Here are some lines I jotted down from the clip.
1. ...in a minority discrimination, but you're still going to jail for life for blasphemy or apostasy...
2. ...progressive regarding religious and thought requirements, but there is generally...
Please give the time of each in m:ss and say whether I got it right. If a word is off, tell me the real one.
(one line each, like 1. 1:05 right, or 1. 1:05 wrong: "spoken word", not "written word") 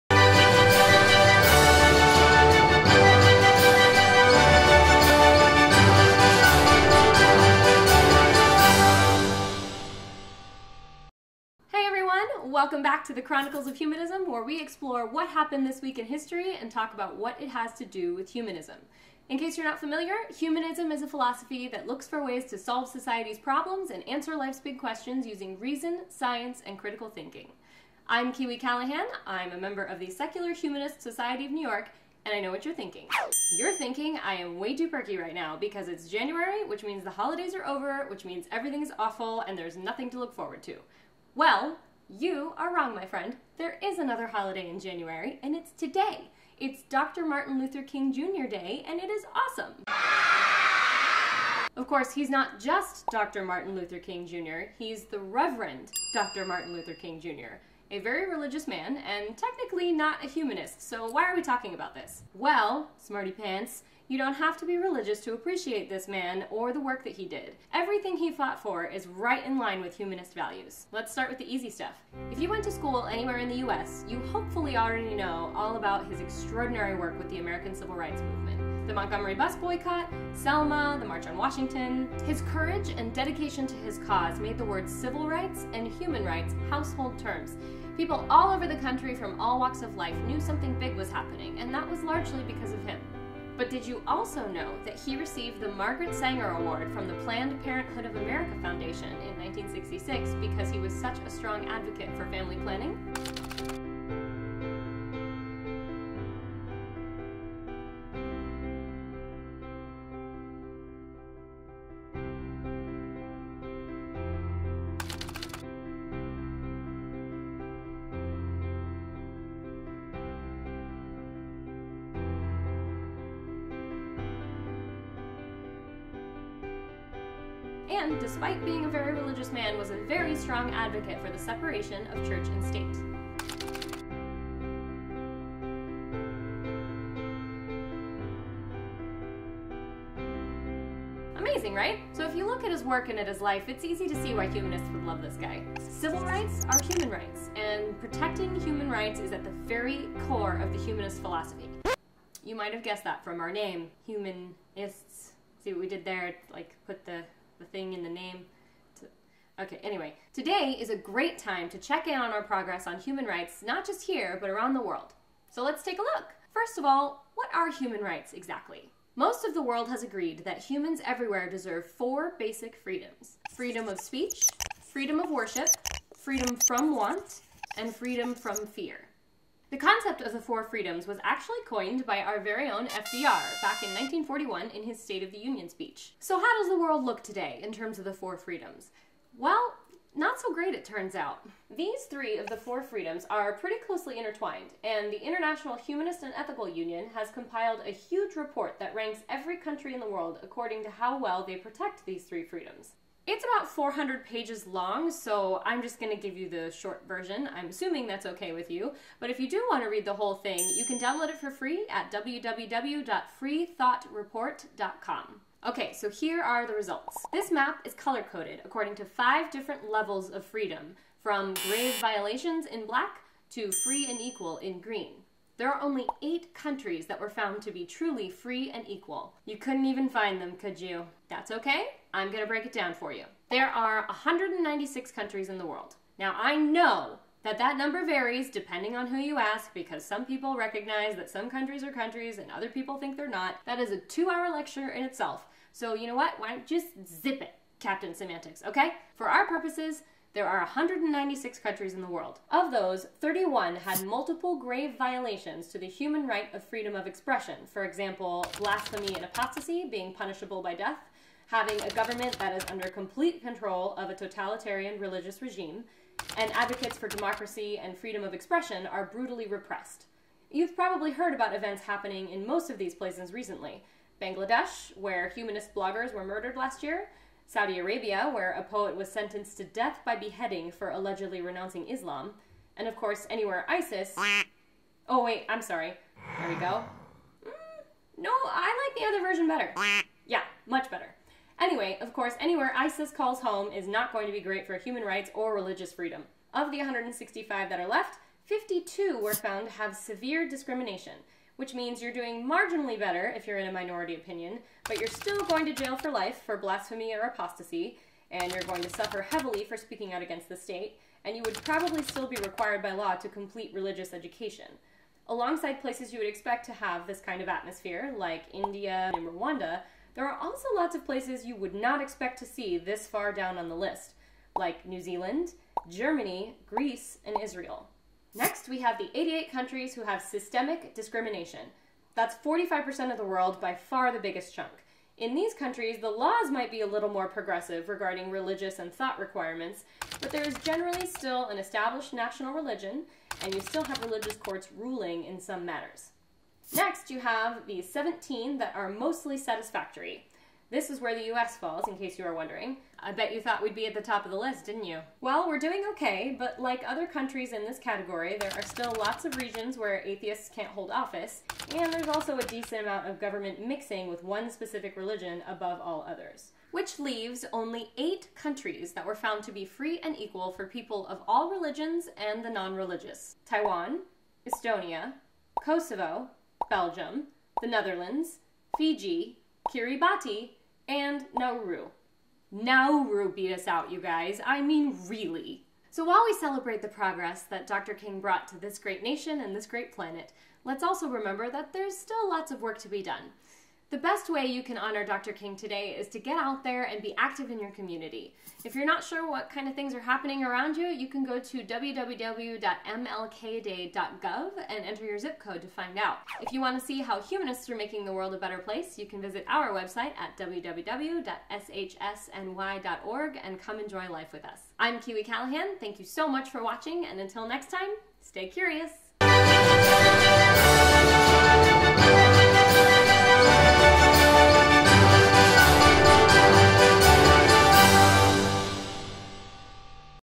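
1. 5:03 wrong: "opinion", not "discrimination"
2. 5:37 right.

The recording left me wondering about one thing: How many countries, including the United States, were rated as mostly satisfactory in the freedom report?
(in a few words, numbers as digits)
17.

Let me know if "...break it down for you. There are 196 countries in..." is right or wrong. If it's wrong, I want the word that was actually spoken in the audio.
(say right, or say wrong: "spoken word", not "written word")
right.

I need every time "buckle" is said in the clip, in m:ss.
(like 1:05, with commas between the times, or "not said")
not said.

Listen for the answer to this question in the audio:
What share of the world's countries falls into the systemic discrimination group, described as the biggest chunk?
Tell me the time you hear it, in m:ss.
5:32.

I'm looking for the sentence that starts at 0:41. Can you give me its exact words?
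Well, you are wrong, my friend.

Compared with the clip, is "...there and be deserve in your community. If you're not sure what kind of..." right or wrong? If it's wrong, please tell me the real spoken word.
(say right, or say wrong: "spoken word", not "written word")
wrong: "active", not "deserve".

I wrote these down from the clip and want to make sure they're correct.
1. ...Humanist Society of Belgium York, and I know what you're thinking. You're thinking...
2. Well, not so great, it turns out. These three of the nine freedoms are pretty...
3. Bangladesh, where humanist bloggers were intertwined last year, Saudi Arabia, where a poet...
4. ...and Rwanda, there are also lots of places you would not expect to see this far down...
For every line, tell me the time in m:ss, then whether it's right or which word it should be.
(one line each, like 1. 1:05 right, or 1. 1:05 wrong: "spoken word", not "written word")
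1. 0:30 wrong: "New", not "Belgium"
2. 3:09 wrong: "four", not "nine"
3. 4:34 wrong: "murdered", not "intertwined"
4. 5:19 right.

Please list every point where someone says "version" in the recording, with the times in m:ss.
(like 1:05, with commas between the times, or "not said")
3:27, 4:49.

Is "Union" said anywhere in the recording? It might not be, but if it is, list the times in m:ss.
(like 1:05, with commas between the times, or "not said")
3:05, 3:16.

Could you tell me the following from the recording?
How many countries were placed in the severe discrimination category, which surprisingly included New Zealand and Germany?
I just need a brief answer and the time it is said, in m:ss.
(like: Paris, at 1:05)
52, at 4:58.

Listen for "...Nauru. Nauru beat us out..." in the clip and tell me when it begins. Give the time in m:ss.
6:21.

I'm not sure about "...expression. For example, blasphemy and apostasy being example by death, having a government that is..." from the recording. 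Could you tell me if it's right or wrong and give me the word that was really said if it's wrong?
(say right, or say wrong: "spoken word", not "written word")
wrong: "punishable", not "example".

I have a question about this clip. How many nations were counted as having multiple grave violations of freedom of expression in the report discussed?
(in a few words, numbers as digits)
31.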